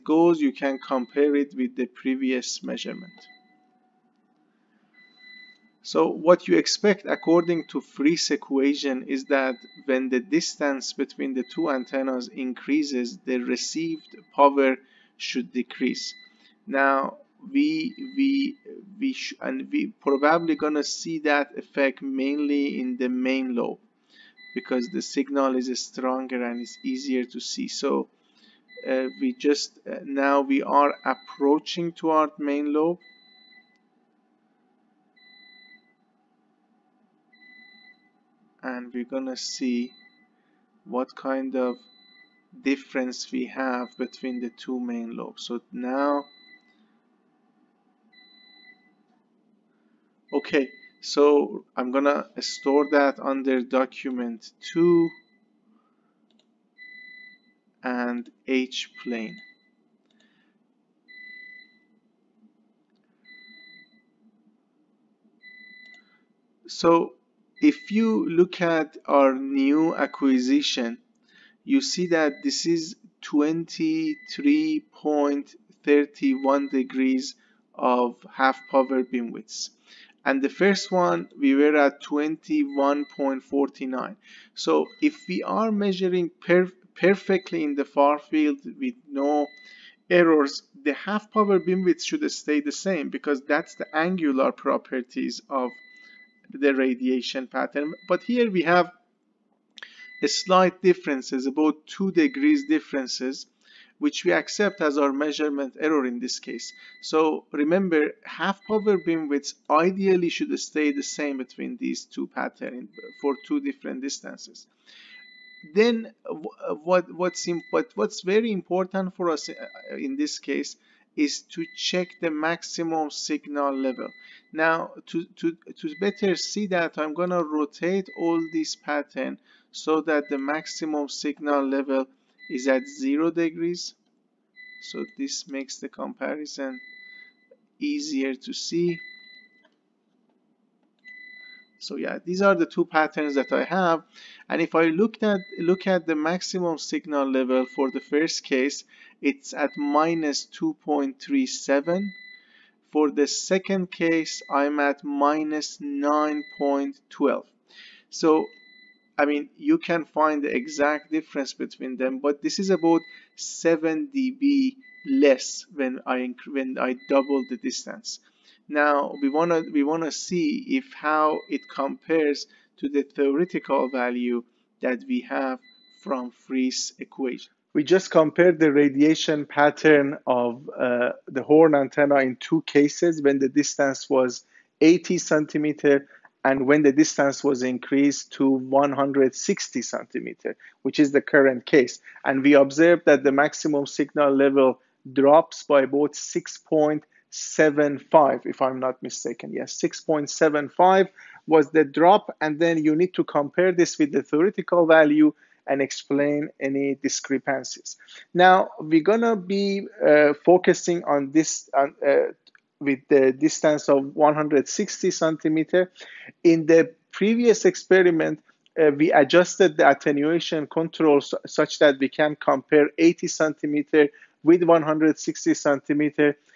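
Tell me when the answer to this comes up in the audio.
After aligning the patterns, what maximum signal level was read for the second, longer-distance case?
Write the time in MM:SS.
02:35.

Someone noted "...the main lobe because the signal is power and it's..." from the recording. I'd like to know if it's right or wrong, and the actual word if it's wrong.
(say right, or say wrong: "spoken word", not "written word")
wrong: "stronger", not "power".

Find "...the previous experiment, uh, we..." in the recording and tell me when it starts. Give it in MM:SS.
03:36.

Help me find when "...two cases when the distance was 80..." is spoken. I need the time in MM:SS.
03:02.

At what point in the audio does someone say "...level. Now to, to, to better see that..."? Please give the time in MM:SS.
02:03.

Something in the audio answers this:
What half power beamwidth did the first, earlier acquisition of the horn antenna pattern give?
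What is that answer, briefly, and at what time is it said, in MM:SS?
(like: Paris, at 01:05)
21.49, at 01:22.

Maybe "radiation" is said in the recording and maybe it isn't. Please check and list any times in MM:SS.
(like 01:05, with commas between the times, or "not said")
01:36, 02:58.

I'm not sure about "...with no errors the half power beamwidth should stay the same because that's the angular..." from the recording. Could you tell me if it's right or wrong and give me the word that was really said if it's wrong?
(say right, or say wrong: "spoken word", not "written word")
right.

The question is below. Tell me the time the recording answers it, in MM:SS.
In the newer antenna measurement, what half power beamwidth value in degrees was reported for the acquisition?
01:13.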